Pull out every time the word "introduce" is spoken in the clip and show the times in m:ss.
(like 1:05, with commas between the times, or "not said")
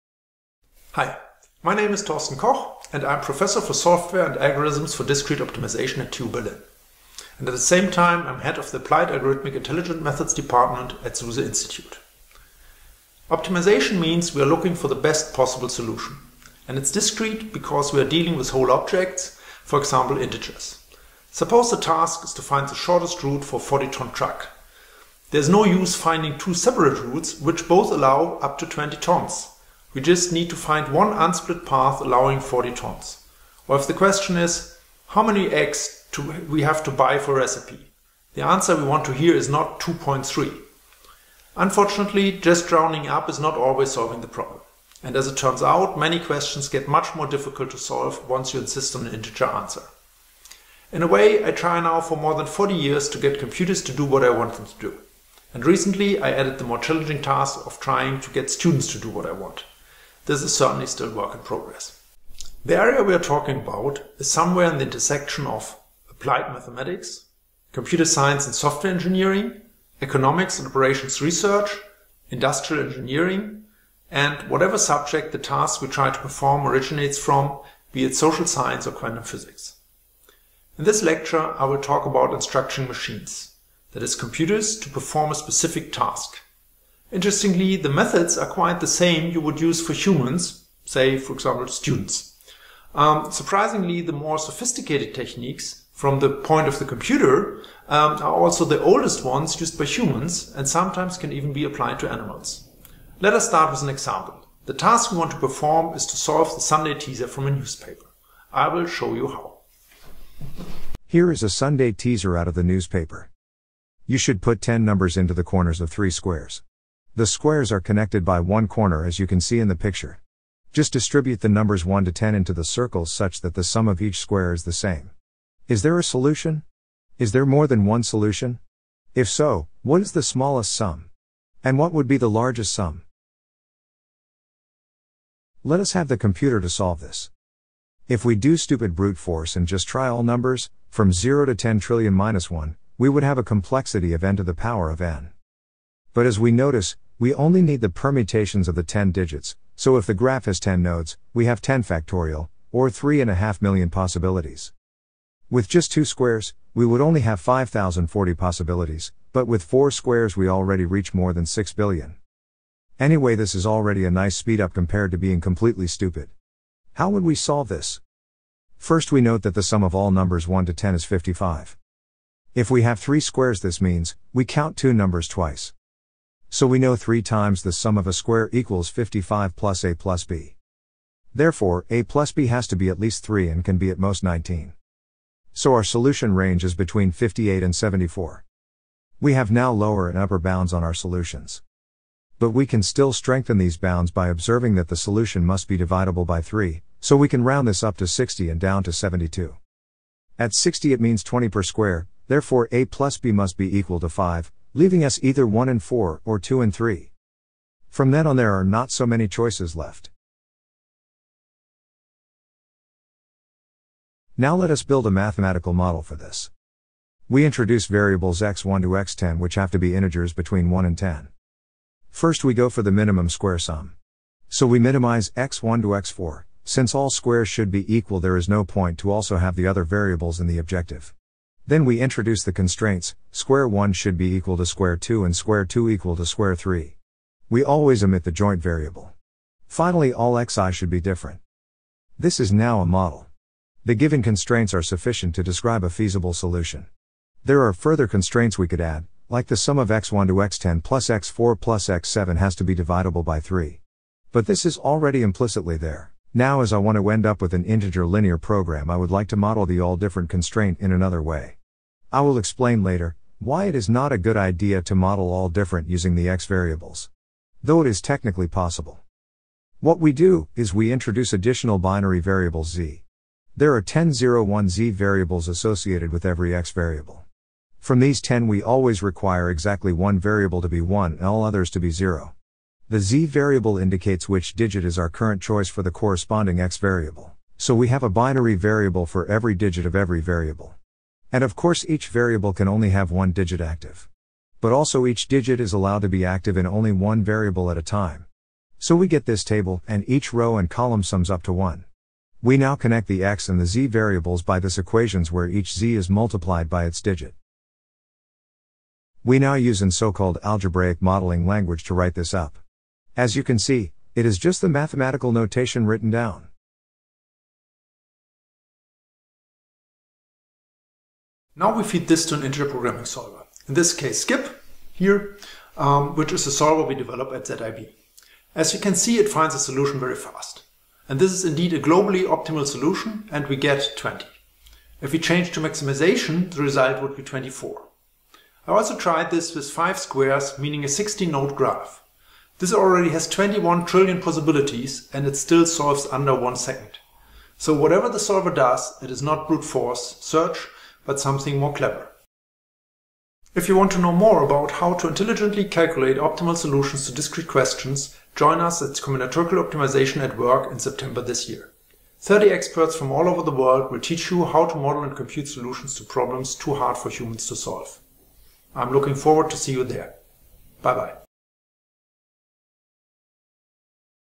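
3:37, 3:52, 4:30.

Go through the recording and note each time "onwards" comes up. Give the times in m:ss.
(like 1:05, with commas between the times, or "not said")
not said.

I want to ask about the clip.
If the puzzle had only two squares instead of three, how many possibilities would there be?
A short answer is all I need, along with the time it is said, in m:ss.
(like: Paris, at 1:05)
5,040, at 2:37.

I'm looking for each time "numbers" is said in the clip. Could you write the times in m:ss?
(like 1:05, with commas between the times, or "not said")
1:54, 2:01, 2:20, 2:50, 2:54.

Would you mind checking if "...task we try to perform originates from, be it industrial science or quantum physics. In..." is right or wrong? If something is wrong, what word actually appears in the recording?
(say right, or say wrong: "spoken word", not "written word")
wrong: "social", not "industrial".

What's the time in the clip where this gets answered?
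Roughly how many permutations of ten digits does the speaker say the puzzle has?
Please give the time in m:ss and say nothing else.
2:32.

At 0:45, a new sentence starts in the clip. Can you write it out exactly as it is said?
And as it turns out, many questions get much more difficult to solve once you insist on an integer answer.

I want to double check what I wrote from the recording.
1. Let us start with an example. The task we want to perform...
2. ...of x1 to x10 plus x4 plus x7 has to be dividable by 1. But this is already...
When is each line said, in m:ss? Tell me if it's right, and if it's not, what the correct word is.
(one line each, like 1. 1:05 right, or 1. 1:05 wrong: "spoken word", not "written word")
1. 1:43 right
2. 4:09 wrong: "3", not "1".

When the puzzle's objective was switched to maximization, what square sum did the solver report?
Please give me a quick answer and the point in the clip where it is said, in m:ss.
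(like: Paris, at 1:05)
24, at 5:37.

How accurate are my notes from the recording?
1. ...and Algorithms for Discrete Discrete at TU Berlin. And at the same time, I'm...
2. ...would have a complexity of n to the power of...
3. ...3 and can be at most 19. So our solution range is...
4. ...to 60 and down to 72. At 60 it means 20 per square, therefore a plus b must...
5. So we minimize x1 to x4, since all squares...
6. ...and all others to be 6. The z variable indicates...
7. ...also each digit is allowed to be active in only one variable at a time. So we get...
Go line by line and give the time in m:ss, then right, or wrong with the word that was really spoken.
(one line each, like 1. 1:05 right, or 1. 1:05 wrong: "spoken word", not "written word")
1. 0:04 wrong: "Optimization", not "Discrete"
2. 2:23 right
3. 3:03 right
4. 3:17 right
5. 3:44 right
6. 4:41 wrong: "0", not "6"
7. 4:54 right.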